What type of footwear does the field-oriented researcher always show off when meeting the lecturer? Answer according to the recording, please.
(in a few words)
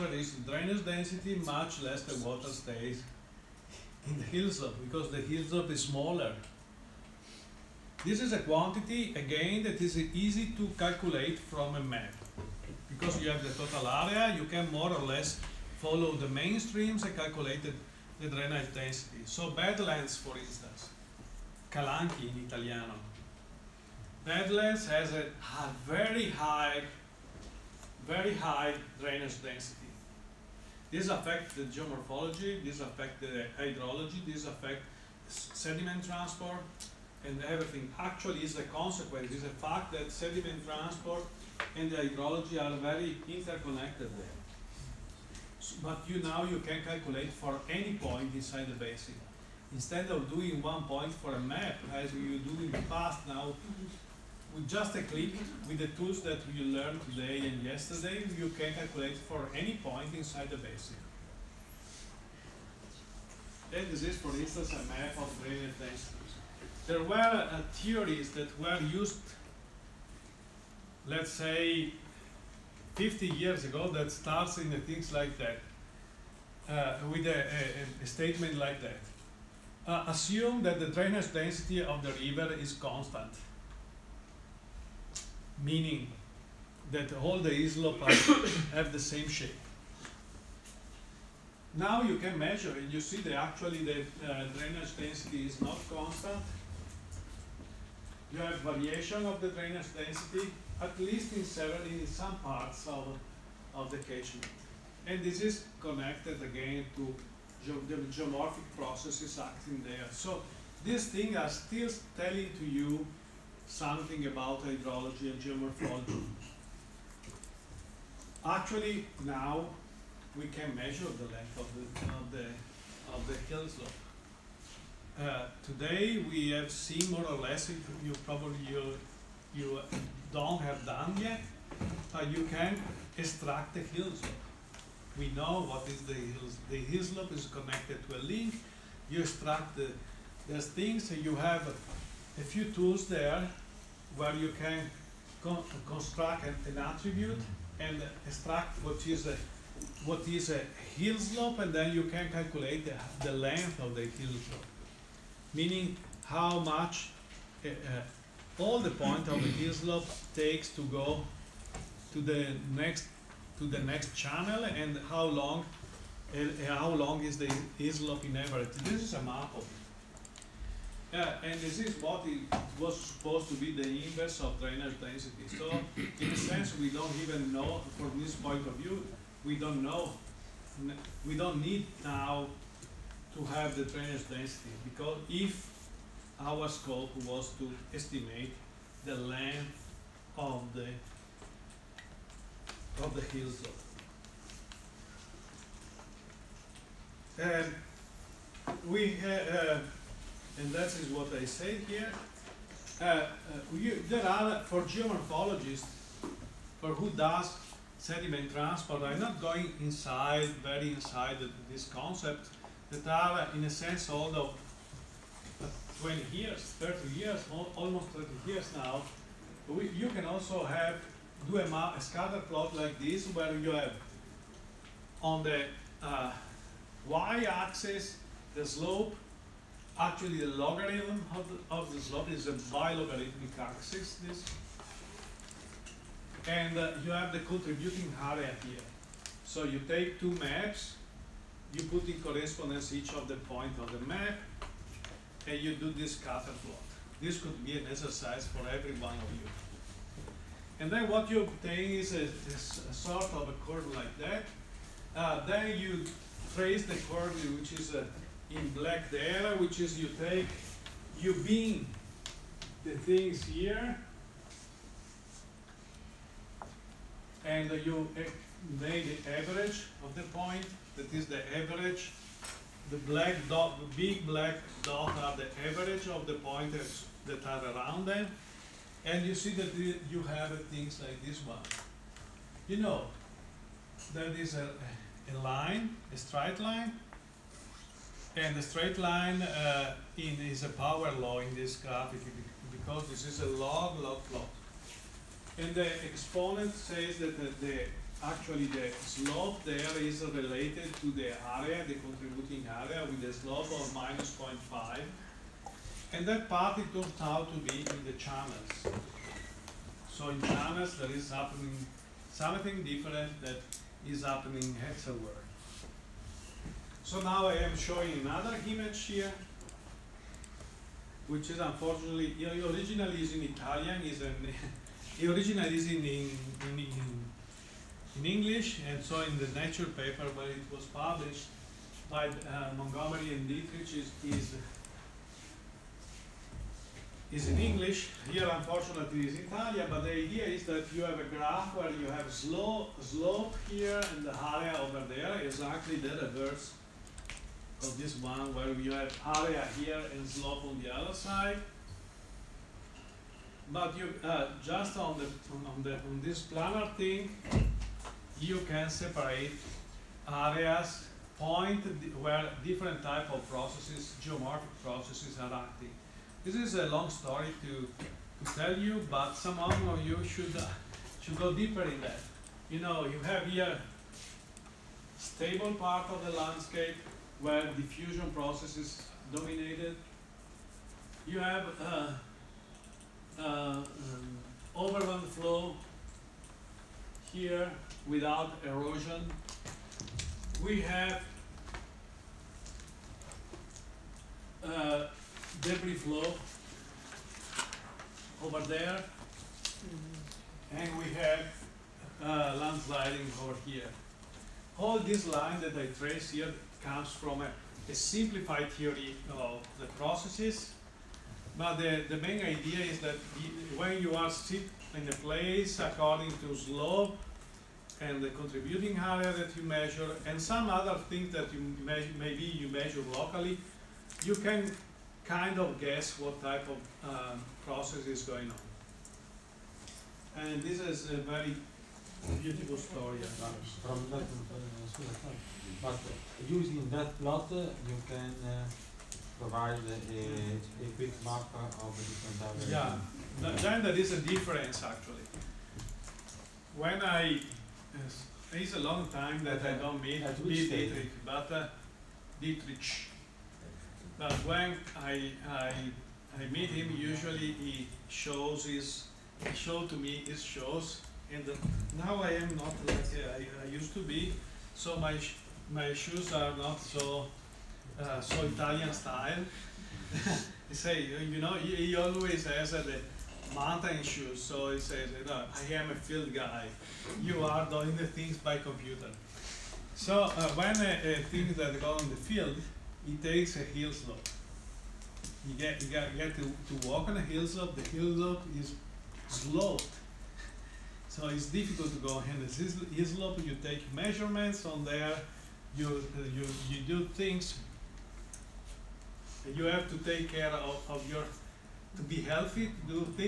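Mountain shoes.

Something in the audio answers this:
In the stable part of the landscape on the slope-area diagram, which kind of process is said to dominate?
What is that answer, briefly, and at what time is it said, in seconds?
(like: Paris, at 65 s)
Diffusion, at 377 s.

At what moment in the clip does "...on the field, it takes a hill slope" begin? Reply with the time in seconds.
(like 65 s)
481 s.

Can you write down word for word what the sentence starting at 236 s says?
And uh, you have the contributing area here.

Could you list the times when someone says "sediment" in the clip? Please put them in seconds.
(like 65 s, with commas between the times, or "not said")
35 s, 40 s, 207 s.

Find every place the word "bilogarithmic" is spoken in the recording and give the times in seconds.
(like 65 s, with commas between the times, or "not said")
232 s.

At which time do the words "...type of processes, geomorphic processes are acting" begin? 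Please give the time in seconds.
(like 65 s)
363 s.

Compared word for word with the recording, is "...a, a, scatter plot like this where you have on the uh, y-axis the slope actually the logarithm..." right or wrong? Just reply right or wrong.
right.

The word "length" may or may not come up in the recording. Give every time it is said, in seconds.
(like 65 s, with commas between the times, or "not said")
121 s, 153 s, 189 s.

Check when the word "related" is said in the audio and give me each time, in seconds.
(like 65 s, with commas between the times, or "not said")
300 s.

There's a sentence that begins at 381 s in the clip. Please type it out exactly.
You have uh, uh, um, overland flow here without erosion.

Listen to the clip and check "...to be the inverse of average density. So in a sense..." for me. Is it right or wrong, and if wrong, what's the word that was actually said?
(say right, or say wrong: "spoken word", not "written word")
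wrong: "drainage", not "average".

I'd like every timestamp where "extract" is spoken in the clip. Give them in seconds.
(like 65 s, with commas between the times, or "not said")
133 s, 139 s, 148 s.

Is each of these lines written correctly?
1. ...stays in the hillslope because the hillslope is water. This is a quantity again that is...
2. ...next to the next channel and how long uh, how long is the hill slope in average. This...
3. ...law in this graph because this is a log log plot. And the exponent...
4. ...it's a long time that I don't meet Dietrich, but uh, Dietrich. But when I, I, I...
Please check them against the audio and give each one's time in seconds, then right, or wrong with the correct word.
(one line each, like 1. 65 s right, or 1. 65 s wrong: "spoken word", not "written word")
1. 2 s wrong: "smaller", not "water"
2. 162 s right
3. 291 s right
4. 448 s right.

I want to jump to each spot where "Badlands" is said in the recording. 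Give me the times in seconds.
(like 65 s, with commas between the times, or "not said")
19 s, 24 s.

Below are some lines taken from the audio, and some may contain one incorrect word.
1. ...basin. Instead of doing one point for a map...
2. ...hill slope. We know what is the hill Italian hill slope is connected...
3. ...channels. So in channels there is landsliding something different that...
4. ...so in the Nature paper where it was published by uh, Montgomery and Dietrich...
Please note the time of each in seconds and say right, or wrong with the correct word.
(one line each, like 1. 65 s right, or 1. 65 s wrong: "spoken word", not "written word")
1. 48 s right
2. 133 s wrong: "The", not "Italian"
3. 308 s wrong: "happening", not "landsliding"
4. 329 s right.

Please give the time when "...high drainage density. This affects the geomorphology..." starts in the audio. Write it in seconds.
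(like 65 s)
28 s.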